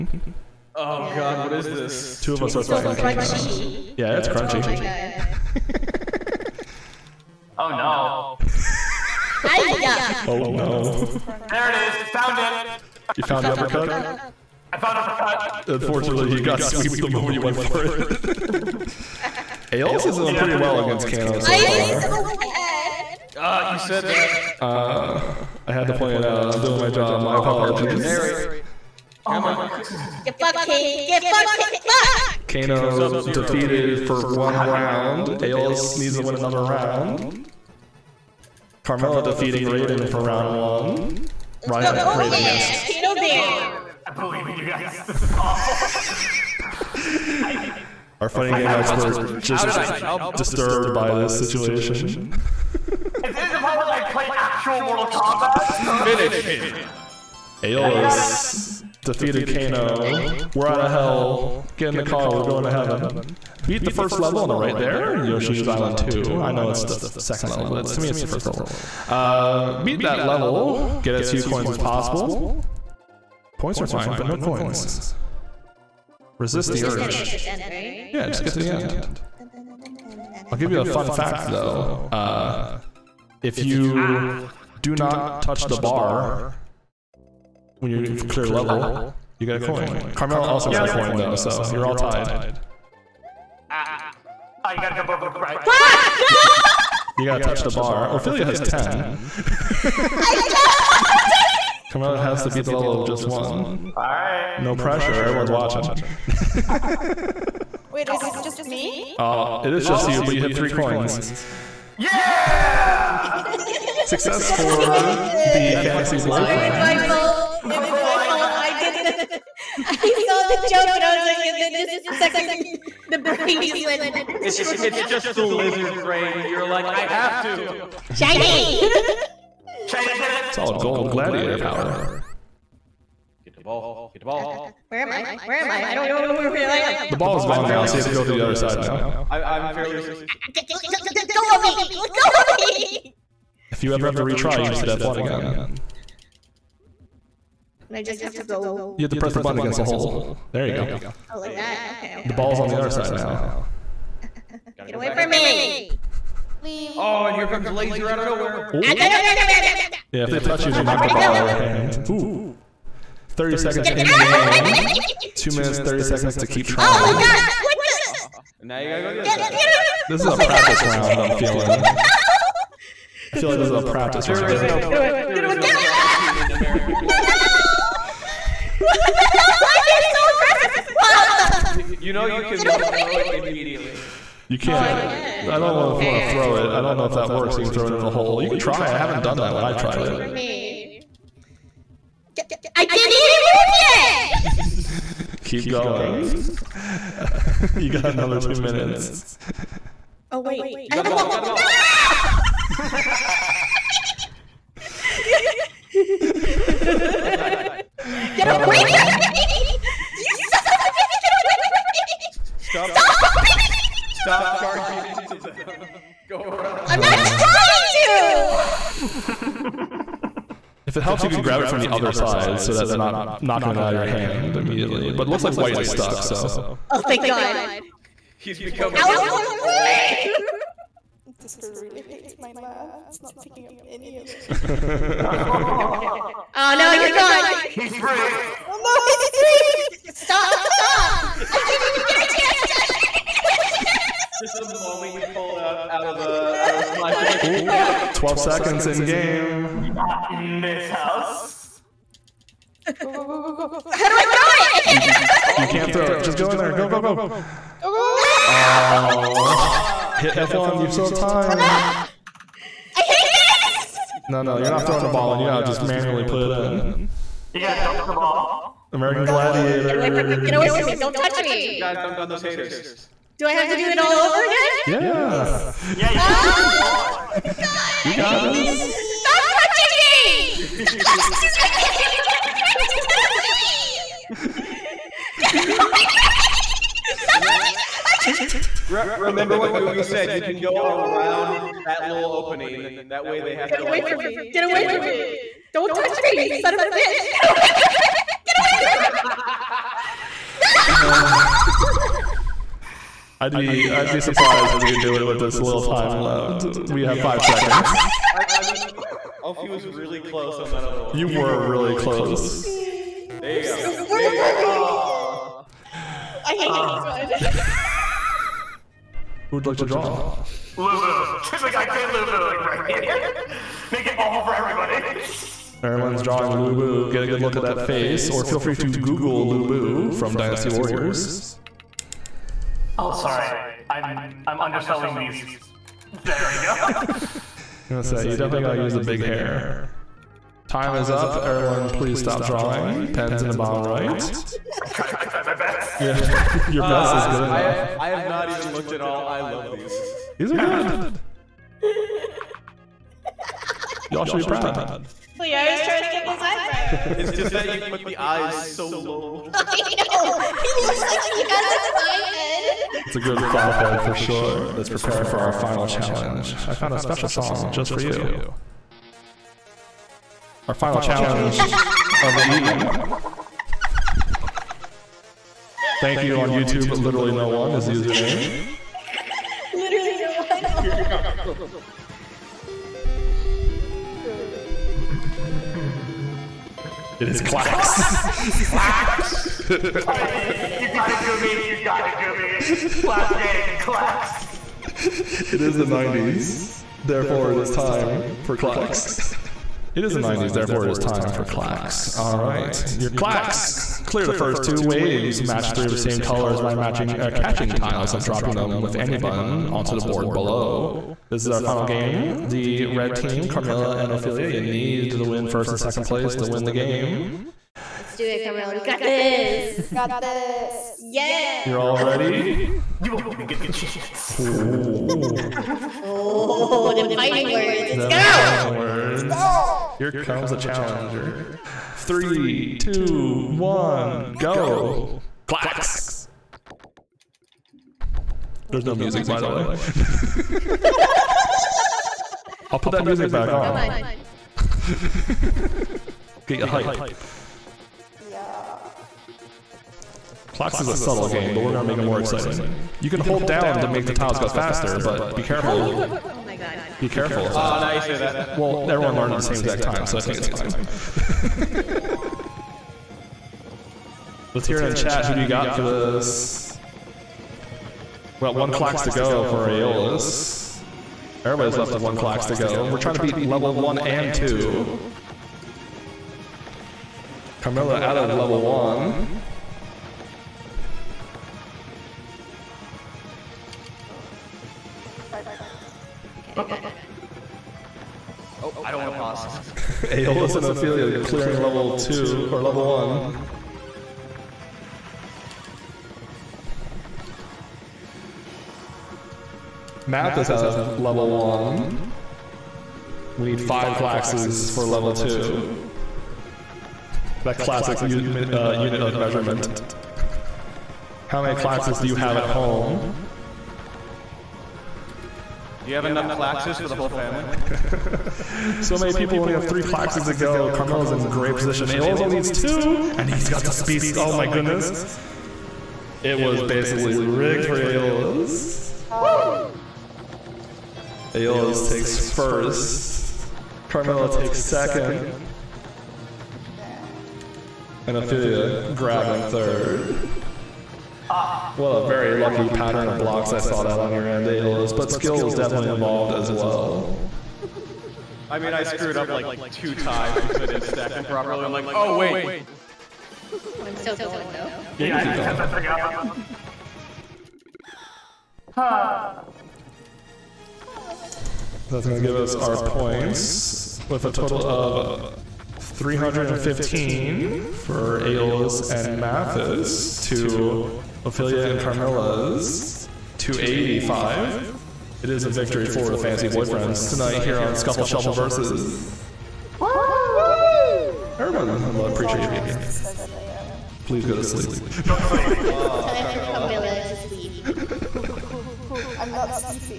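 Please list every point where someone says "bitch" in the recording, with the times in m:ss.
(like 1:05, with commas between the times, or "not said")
3:30, 4:56.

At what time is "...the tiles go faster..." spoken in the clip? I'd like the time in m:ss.
7:34.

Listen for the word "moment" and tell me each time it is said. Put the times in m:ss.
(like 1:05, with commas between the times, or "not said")
0:17, 4:04.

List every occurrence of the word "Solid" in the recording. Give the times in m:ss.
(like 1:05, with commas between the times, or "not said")
2:10.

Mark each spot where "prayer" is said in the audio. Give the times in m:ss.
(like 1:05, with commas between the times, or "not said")
not said.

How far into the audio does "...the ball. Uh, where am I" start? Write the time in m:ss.
2:14.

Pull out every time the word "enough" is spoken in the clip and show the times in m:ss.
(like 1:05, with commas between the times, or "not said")
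5:47, 8:36.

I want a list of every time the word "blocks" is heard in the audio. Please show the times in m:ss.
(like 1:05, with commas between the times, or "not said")
9:03.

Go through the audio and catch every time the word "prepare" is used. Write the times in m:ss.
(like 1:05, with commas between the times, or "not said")
6:04.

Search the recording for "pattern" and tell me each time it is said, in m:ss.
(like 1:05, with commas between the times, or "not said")
9:02.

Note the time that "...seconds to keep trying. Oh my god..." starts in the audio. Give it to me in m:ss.
2:46.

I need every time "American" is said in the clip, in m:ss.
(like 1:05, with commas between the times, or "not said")
2:56, 4:28.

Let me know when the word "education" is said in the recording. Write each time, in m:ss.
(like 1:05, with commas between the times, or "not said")
not said.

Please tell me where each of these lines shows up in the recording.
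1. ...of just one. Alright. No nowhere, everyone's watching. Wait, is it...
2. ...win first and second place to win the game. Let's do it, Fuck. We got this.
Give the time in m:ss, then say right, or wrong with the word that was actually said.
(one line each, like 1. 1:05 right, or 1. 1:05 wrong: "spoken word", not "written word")
1. 1:42 wrong: "pressure", not "nowhere"
2. 6:55 wrong: "Carmilla", not "Fuck".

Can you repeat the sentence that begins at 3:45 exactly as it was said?
But looks like White is stuck, so.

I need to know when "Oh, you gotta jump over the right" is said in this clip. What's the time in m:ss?
1:34.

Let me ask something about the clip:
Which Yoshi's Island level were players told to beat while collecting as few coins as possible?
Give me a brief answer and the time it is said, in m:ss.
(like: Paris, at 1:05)
Yoshi's Island 2, at 1:05.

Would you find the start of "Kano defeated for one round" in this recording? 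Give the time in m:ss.
0:32.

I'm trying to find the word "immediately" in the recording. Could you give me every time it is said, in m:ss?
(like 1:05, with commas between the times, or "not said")
3:03, 3:44.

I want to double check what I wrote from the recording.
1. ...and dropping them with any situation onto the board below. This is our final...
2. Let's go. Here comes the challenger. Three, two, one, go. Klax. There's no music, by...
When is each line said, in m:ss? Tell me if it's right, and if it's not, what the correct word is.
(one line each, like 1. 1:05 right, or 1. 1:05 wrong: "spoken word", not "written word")
1. 6:48 wrong: "button", not "situation"
2. 7:09 right.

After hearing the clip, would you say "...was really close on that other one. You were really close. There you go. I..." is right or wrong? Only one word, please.
right.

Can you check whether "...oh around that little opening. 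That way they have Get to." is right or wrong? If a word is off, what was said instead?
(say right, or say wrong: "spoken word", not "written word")
right.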